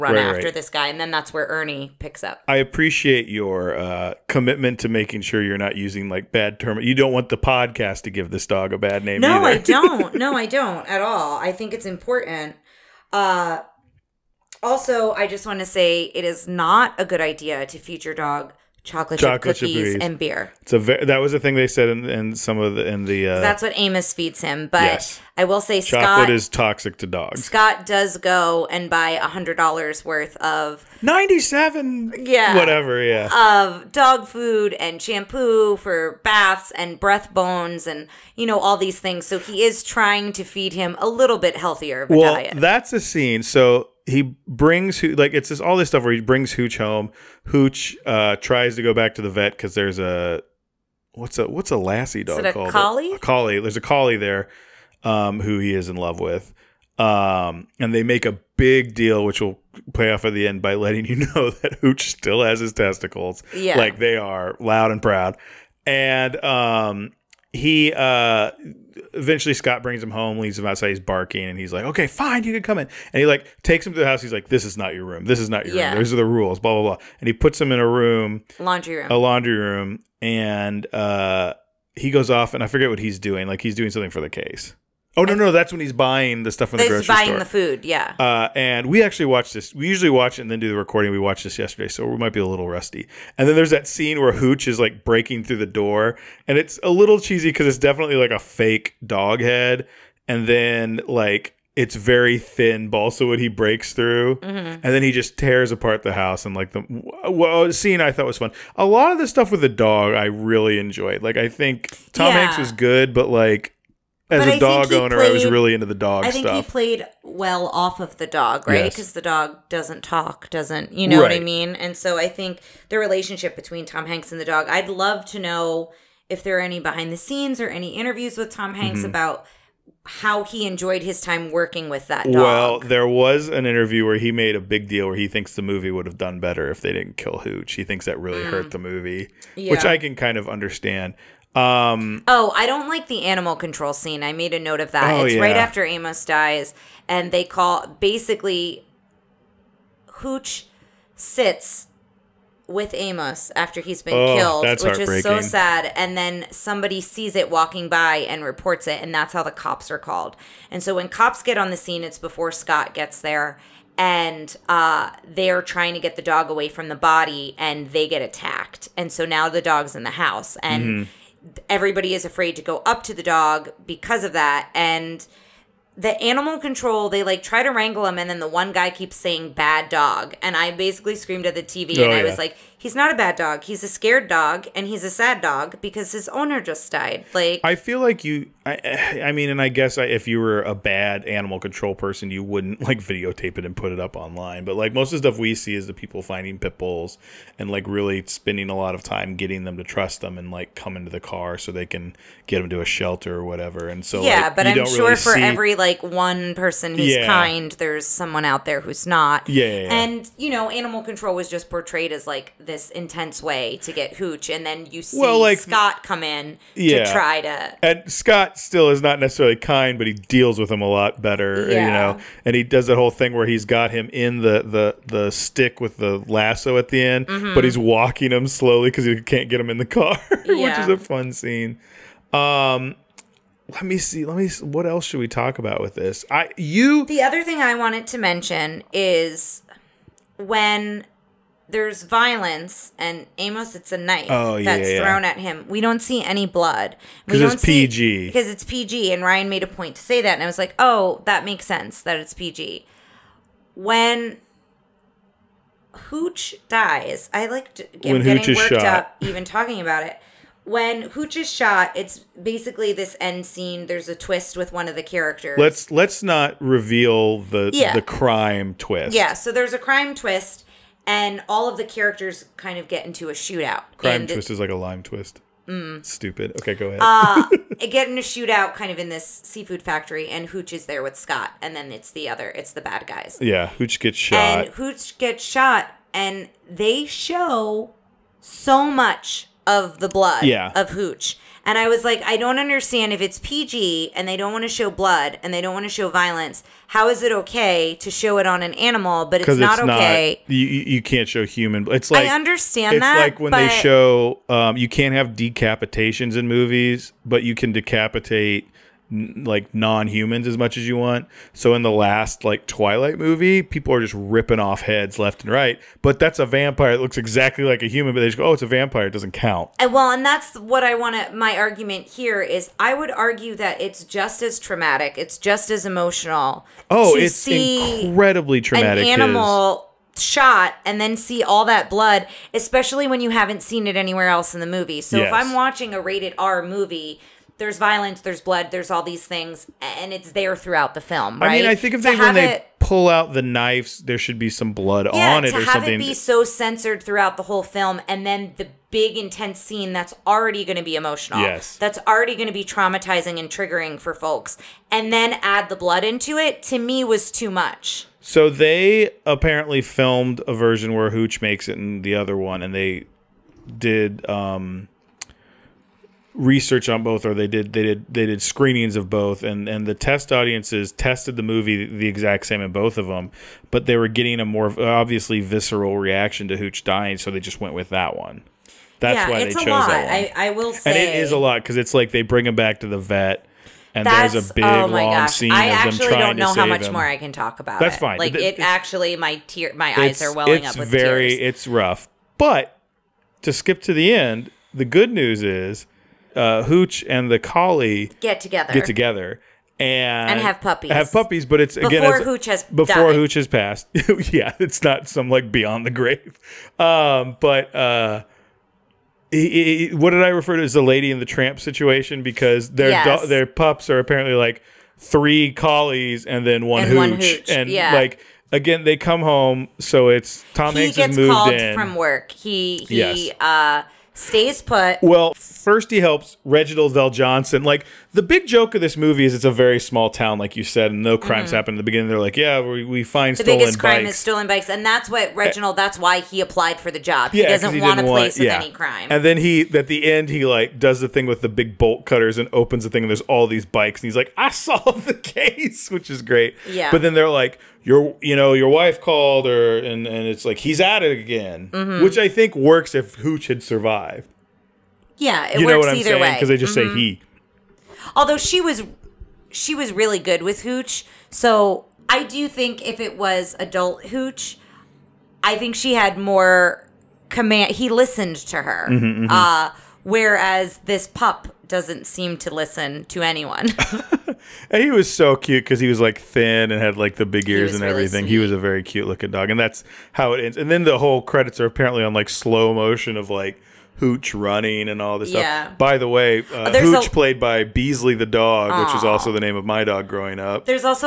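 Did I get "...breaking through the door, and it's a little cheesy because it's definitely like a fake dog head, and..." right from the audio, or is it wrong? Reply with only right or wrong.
right.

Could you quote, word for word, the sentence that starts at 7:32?
which i think works if hooch had survived yeah it you works know what i'm either way because they just mm-hmm.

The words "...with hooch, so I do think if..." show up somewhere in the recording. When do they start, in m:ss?
7:40.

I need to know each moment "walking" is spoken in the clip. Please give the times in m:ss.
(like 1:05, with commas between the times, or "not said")
2:37, 3:47.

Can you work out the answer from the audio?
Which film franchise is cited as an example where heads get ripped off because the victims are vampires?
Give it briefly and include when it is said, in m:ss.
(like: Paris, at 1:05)
Twilight, at 5:12.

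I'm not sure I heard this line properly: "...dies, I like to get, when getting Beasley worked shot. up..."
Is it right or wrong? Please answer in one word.
wrong.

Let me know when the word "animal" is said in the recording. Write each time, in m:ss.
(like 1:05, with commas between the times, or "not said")
2:23, 2:56, 3:11, 3:30, 4:58, 5:29.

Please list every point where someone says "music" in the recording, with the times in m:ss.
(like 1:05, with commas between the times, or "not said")
not said.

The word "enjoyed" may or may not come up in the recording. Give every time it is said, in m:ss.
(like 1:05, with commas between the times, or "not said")
1:50, 2:10.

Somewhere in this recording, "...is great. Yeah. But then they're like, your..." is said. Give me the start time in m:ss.
7:26.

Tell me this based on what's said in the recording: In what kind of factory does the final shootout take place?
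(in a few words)
Seafood factory.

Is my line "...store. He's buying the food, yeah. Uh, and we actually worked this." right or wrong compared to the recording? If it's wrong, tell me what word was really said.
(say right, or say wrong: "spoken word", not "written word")
wrong: "watched", not "worked".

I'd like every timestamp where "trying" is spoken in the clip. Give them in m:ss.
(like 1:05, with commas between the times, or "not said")
0:39, 2:45, 6:25.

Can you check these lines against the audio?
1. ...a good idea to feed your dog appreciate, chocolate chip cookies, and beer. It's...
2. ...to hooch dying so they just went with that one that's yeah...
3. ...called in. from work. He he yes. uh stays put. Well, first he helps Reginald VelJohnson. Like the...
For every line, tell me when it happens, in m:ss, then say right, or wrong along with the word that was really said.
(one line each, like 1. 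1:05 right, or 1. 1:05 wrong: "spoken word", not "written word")
1. 0:16 wrong: "chocolate", not "appreciate"
2. 6:16 right
3. 7:01 right.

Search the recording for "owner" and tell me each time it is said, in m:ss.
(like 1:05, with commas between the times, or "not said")
1:54, 3:06.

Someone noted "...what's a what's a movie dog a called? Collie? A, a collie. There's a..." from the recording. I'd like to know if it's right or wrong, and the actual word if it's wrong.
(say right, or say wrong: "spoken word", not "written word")
wrong: "lassie", not "movie".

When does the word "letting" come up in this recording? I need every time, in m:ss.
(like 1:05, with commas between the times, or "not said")
1:00.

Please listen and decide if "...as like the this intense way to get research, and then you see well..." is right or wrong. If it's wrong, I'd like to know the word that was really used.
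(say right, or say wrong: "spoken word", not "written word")
wrong: "hooch", not "research".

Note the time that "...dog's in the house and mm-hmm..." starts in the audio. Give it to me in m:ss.
2:49.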